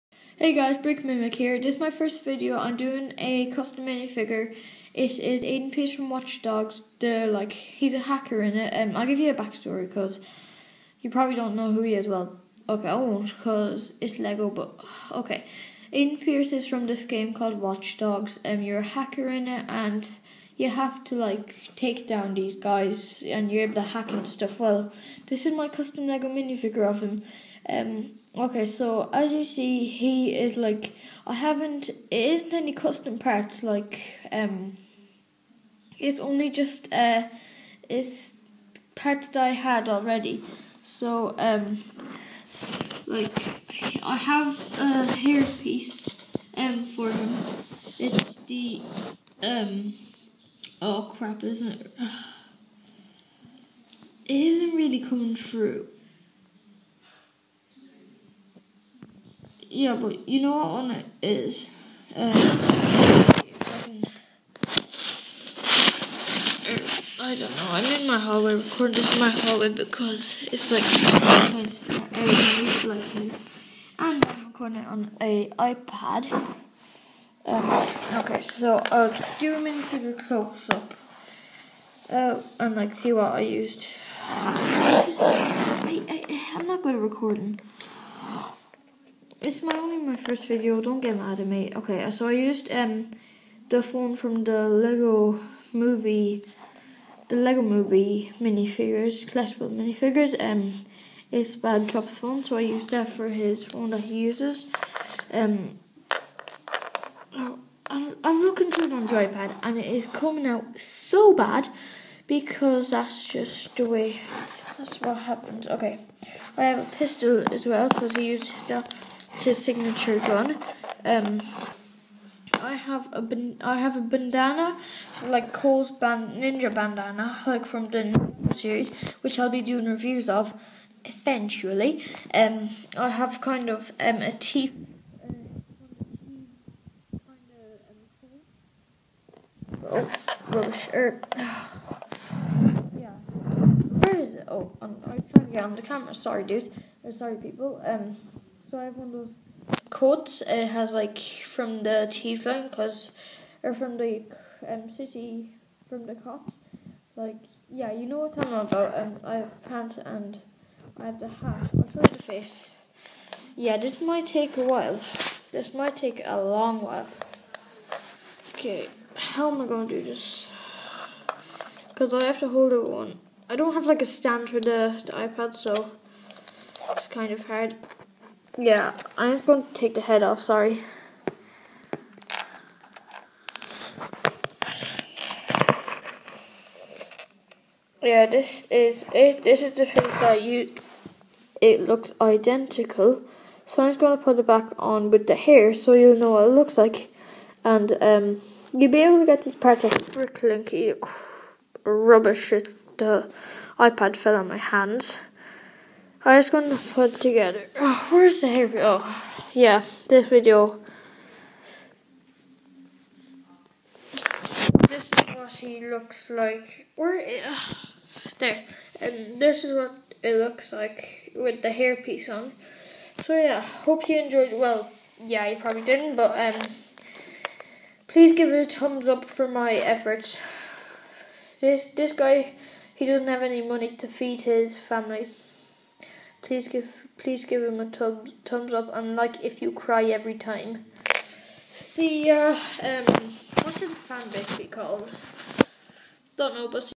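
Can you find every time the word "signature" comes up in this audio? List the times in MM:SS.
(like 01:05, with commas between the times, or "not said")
01:59.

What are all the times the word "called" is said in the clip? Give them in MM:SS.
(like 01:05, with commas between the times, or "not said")
00:17, 04:04.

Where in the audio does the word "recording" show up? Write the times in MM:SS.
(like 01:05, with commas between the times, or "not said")
01:08, 01:14, 01:27.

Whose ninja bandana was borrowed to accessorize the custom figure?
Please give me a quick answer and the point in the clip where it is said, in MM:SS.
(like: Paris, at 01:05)
Cole, at 02:05.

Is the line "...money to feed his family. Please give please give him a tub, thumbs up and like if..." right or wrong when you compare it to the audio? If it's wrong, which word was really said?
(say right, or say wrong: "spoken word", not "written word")
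right.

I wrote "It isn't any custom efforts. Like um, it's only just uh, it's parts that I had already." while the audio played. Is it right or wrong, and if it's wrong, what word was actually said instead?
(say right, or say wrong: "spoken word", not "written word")
wrong: "parts", not "efforts".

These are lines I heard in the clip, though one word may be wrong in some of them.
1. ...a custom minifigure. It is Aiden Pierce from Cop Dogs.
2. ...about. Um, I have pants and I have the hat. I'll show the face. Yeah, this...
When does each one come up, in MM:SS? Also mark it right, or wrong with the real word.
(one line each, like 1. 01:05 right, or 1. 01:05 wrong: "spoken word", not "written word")
1. 00:03 wrong: "Watch", not "Cop"
2. 02:38 right.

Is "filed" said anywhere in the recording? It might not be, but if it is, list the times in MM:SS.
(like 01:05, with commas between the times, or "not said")
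not said.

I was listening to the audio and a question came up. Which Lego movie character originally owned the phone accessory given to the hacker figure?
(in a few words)
Bad Cop.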